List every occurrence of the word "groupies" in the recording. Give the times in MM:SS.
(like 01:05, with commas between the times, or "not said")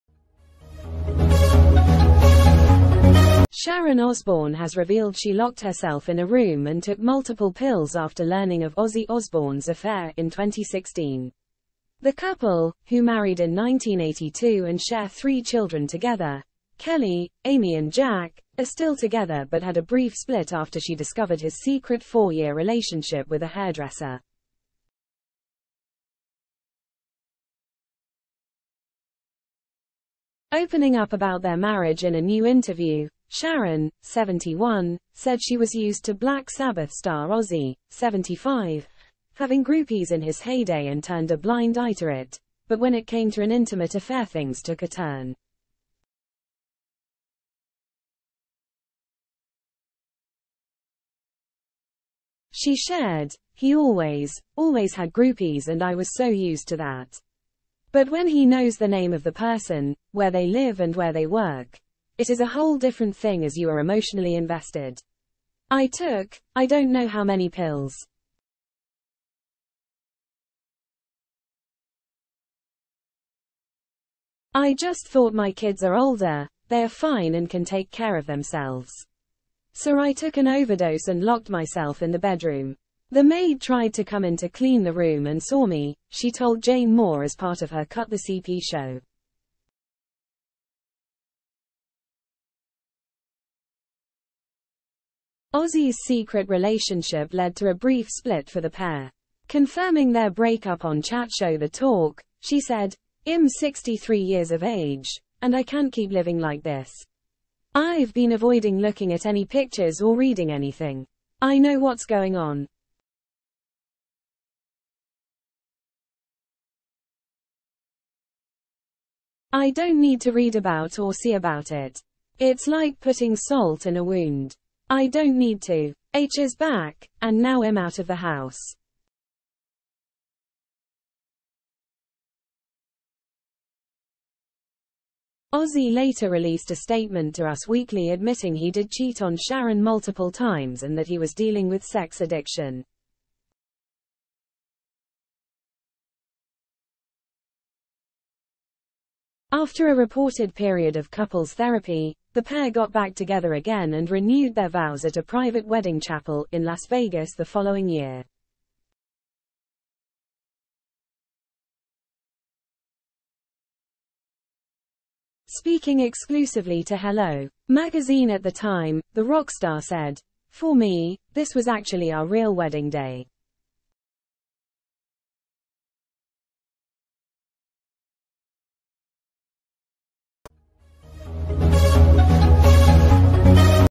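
00:39, 00:55.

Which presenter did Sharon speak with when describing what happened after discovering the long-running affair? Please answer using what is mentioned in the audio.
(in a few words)
Jane Moore.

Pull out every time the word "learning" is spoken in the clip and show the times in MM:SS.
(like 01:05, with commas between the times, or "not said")
00:08.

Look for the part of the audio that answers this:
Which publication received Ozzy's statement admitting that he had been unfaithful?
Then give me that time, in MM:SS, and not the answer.
02:17.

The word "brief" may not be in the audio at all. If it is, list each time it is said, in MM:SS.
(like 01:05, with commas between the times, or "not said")
00:19, 01:37.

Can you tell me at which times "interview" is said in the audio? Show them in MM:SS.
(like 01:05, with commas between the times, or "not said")
00:32.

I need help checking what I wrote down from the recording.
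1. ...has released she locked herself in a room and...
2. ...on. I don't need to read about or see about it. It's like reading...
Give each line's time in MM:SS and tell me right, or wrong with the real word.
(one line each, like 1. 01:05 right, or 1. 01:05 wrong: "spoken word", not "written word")
1. 00:04 wrong: "revealed", not "released"
2. 01:52 wrong: "putting", not "reading".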